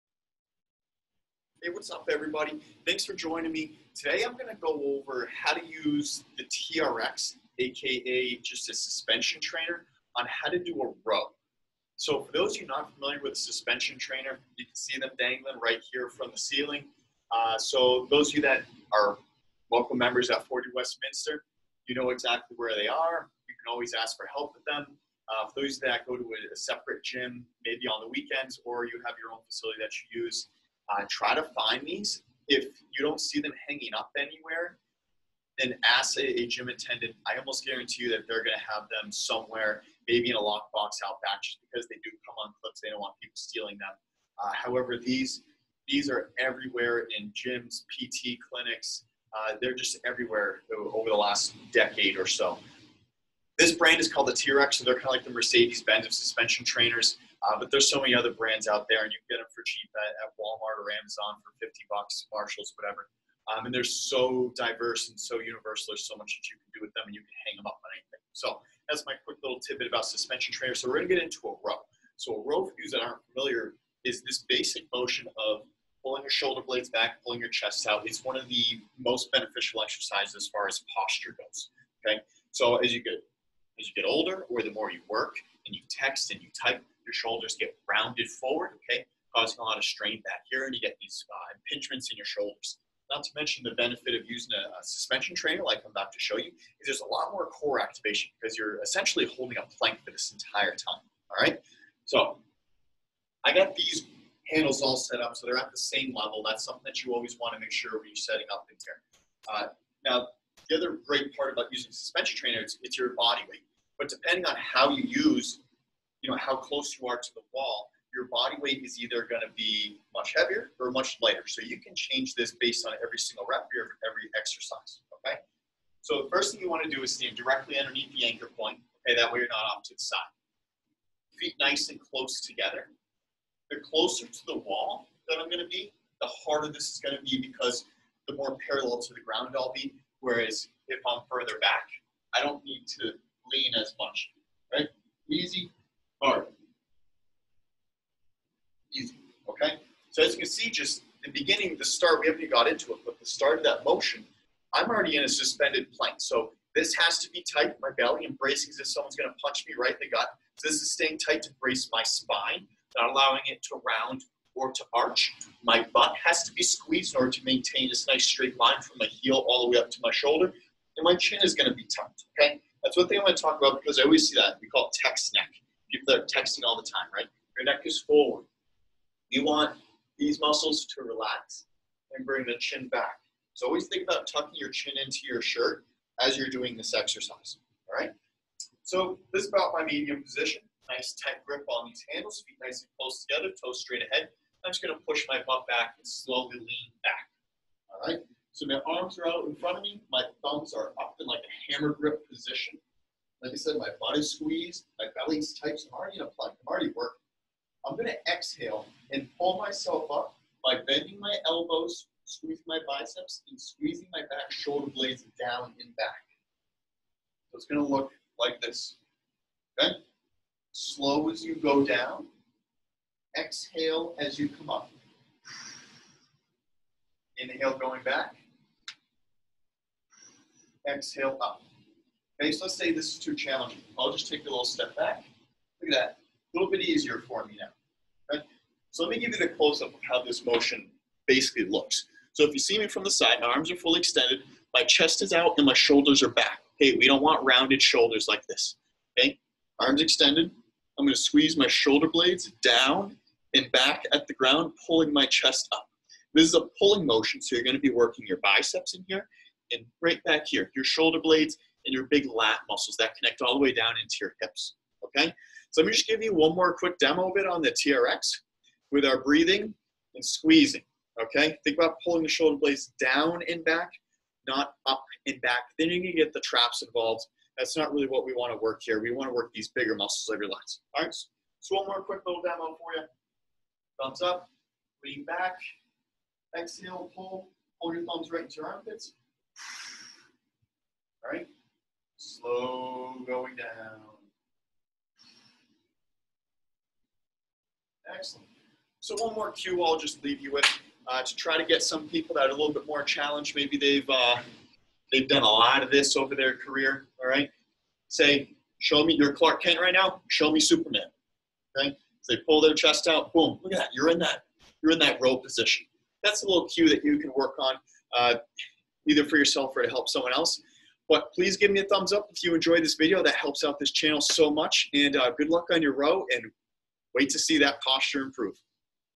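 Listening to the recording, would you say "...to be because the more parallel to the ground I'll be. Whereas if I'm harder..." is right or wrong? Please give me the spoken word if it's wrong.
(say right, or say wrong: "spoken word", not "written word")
wrong: "further", not "harder".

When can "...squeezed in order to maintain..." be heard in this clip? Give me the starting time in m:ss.
2:46.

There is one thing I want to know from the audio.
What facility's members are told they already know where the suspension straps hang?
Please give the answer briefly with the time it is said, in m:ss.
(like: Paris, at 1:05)
40 Westminster, at 0:20.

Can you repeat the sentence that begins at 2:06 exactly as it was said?
So the first thing you want to do is stand directly underneath the anchor point, okay?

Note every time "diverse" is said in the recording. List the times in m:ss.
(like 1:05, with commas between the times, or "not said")
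1:04.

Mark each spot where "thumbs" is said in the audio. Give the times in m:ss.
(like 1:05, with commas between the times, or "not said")
3:20, 4:44, 4:48, 5:21.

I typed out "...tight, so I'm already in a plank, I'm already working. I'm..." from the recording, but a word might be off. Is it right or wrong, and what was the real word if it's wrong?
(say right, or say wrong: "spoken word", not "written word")
right.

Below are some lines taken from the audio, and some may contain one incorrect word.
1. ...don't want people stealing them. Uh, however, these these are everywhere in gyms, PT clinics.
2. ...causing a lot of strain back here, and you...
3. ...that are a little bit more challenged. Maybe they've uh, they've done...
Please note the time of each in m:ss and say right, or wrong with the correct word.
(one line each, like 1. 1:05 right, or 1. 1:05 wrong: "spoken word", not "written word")
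1. 0:42 right
2. 1:29 right
3. 5:02 right.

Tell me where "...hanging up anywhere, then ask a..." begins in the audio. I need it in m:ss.
0:33.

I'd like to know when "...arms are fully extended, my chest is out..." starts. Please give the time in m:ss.
4:03.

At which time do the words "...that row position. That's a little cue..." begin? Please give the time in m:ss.
5:14.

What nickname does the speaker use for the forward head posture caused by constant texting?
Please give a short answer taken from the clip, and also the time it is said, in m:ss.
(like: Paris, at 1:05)
tech neck, at 2:55.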